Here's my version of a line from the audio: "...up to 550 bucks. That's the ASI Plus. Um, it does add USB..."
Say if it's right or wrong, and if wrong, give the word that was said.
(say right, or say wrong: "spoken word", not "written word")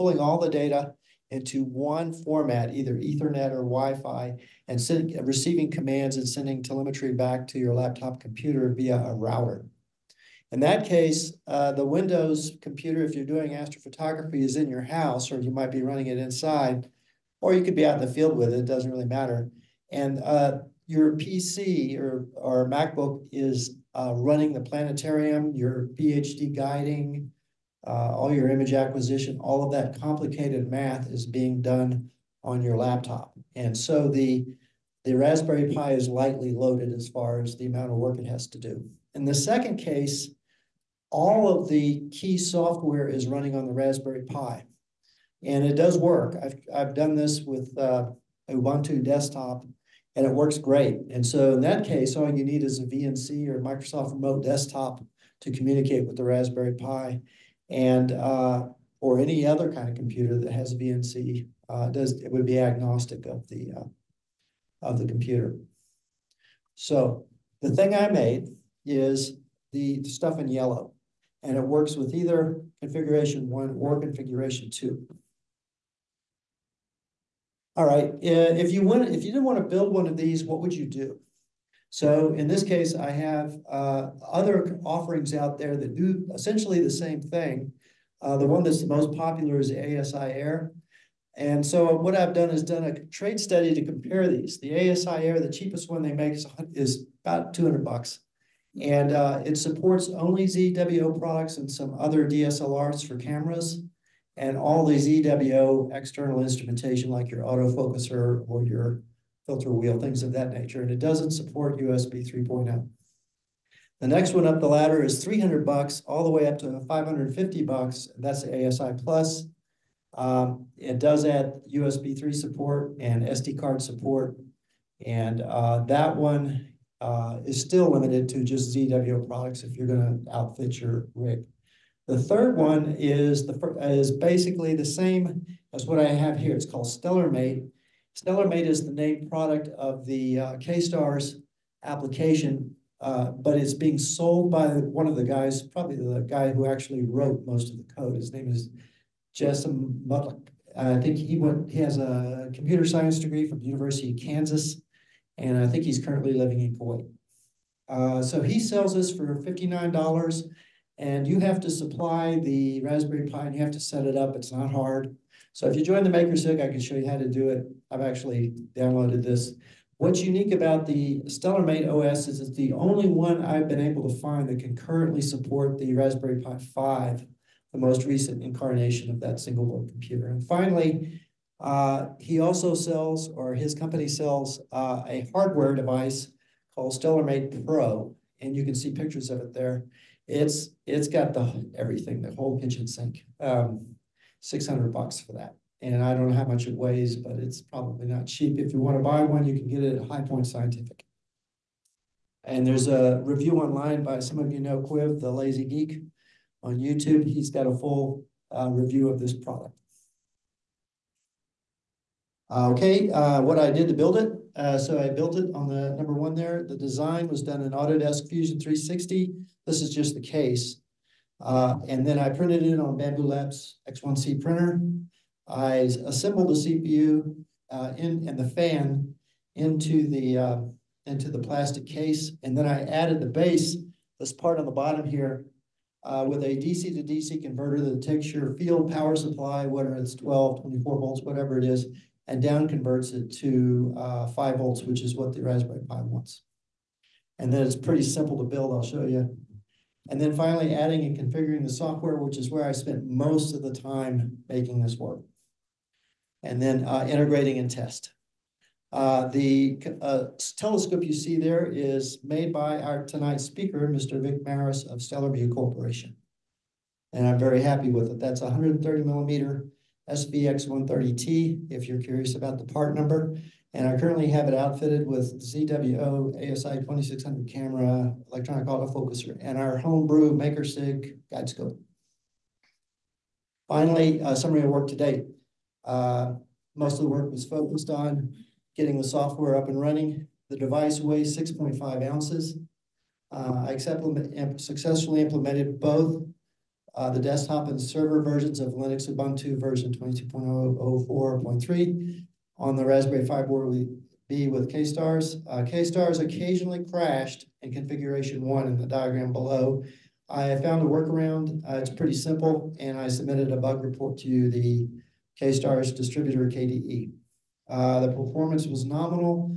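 right.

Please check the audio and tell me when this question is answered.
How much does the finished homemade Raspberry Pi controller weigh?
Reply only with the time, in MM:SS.
04:51.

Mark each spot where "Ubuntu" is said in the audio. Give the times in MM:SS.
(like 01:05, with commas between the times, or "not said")
00:48, 04:59.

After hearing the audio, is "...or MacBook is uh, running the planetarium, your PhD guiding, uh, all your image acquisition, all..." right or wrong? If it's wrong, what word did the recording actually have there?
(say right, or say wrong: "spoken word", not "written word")
right.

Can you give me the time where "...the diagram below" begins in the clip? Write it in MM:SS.
05:08.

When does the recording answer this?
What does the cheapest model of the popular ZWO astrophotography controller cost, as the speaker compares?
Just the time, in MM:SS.
01:37.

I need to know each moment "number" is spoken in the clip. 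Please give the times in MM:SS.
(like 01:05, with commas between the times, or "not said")
03:35, 04:32.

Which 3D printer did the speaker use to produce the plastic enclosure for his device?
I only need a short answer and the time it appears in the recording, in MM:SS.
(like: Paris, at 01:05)
Bambu Labs X1C, at 03:42.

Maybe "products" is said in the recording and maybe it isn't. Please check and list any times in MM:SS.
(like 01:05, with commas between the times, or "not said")
01:41, 02:09, 02:19, 03:29.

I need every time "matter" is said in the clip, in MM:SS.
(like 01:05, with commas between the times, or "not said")
00:19.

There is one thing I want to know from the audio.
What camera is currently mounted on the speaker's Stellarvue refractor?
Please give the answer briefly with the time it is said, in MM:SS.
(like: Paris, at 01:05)
ZWO ASI 2600, at 04:35.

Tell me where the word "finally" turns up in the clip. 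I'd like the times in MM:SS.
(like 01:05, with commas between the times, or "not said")
03:00, 04:10, 04:43.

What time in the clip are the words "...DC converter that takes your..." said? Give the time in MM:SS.
03:57.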